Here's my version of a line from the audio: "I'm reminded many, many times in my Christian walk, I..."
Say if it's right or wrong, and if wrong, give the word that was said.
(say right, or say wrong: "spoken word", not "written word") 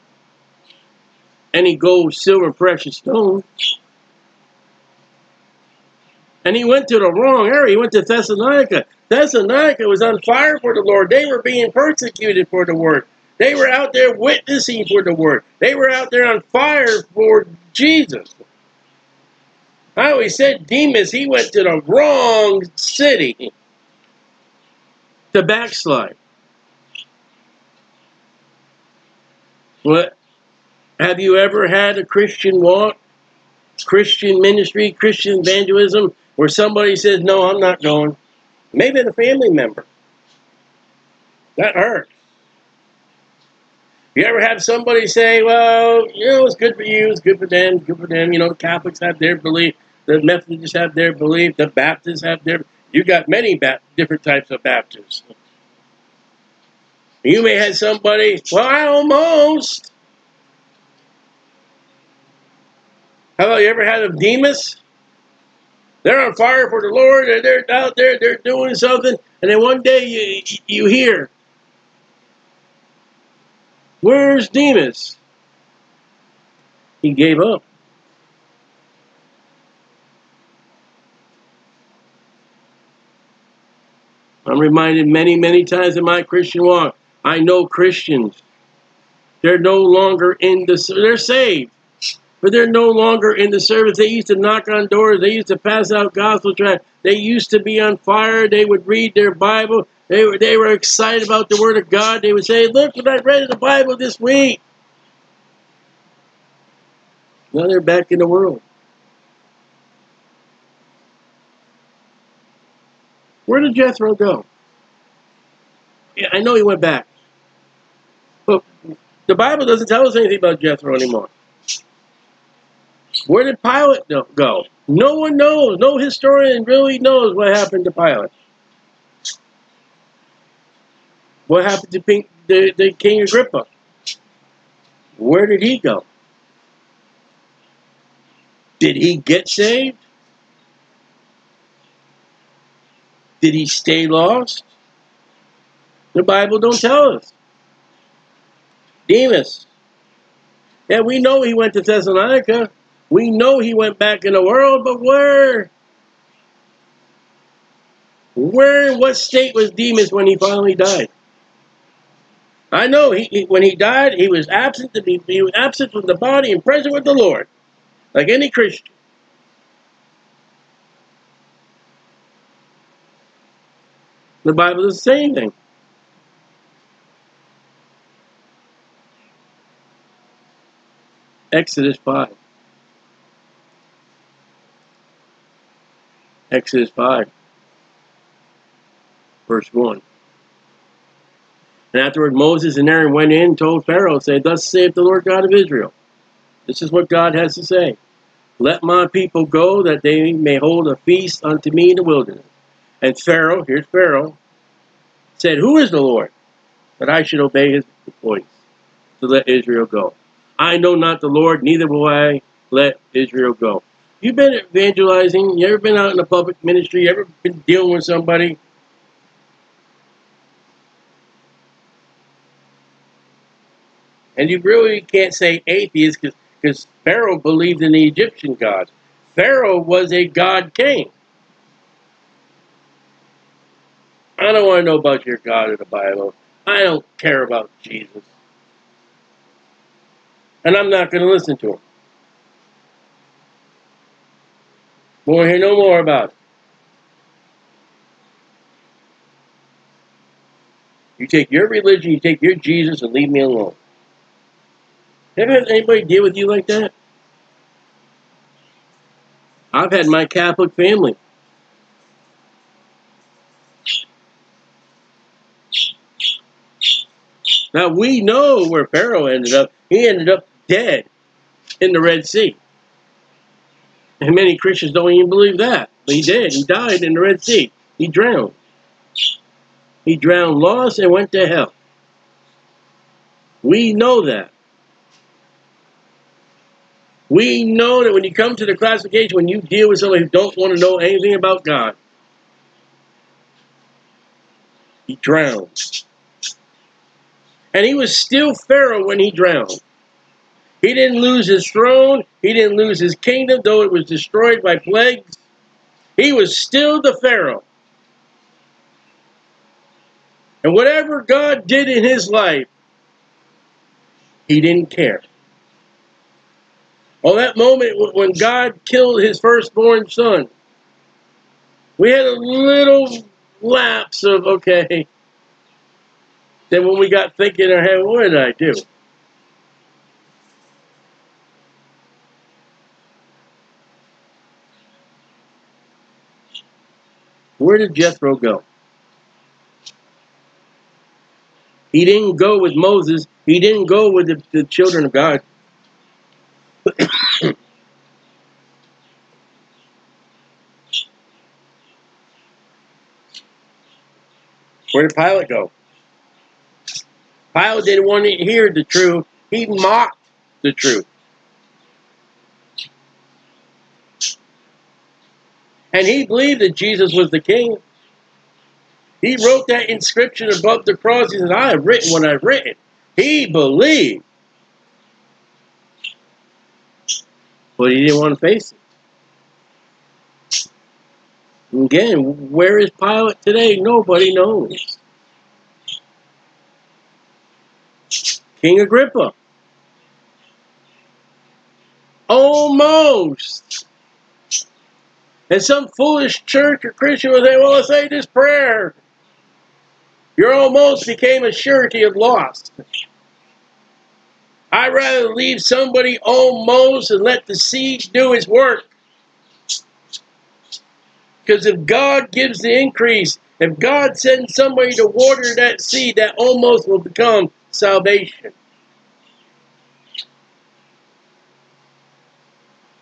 right.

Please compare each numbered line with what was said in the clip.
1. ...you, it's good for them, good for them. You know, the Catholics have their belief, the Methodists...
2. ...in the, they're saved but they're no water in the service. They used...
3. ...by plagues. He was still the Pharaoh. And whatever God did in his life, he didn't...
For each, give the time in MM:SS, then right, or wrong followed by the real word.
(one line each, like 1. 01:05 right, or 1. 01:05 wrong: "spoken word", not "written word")
1. 00:46 right
2. 01:30 wrong: "longer", not "water"
3. 05:04 right.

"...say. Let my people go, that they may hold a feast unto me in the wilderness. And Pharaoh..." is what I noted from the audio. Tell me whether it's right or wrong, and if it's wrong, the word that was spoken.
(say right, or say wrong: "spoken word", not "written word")
right.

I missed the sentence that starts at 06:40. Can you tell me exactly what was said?
You're almost became a surety of loss.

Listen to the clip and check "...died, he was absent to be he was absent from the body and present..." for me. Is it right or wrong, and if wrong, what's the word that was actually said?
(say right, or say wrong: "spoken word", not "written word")
right.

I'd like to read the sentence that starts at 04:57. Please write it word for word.
And he was still Pharaoh when he drowned.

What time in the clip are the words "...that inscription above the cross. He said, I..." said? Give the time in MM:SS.
06:09.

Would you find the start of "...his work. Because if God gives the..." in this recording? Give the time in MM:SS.
06:48.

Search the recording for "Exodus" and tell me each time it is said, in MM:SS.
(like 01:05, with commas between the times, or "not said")
03:01, 03:06.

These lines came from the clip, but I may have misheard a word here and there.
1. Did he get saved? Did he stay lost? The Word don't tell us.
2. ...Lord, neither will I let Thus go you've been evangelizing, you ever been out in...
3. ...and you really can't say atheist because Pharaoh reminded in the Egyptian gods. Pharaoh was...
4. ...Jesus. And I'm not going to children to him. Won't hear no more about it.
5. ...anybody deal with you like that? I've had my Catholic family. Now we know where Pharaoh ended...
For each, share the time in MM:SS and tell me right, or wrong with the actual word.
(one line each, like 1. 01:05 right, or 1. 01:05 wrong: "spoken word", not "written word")
1. 02:18 wrong: "Bible", not "Word"
2. 03:31 wrong: "Israel", not "Thus"
3. 03:44 wrong: "believed", not "reminded"
4. 03:57 wrong: "listen", not "children"
5. 04:15 right.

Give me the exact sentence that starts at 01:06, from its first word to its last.
They're on fire for the Lord.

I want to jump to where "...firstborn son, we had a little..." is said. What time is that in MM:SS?
05:19.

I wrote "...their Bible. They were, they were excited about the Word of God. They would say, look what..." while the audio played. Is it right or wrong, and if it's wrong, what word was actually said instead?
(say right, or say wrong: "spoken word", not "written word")
right.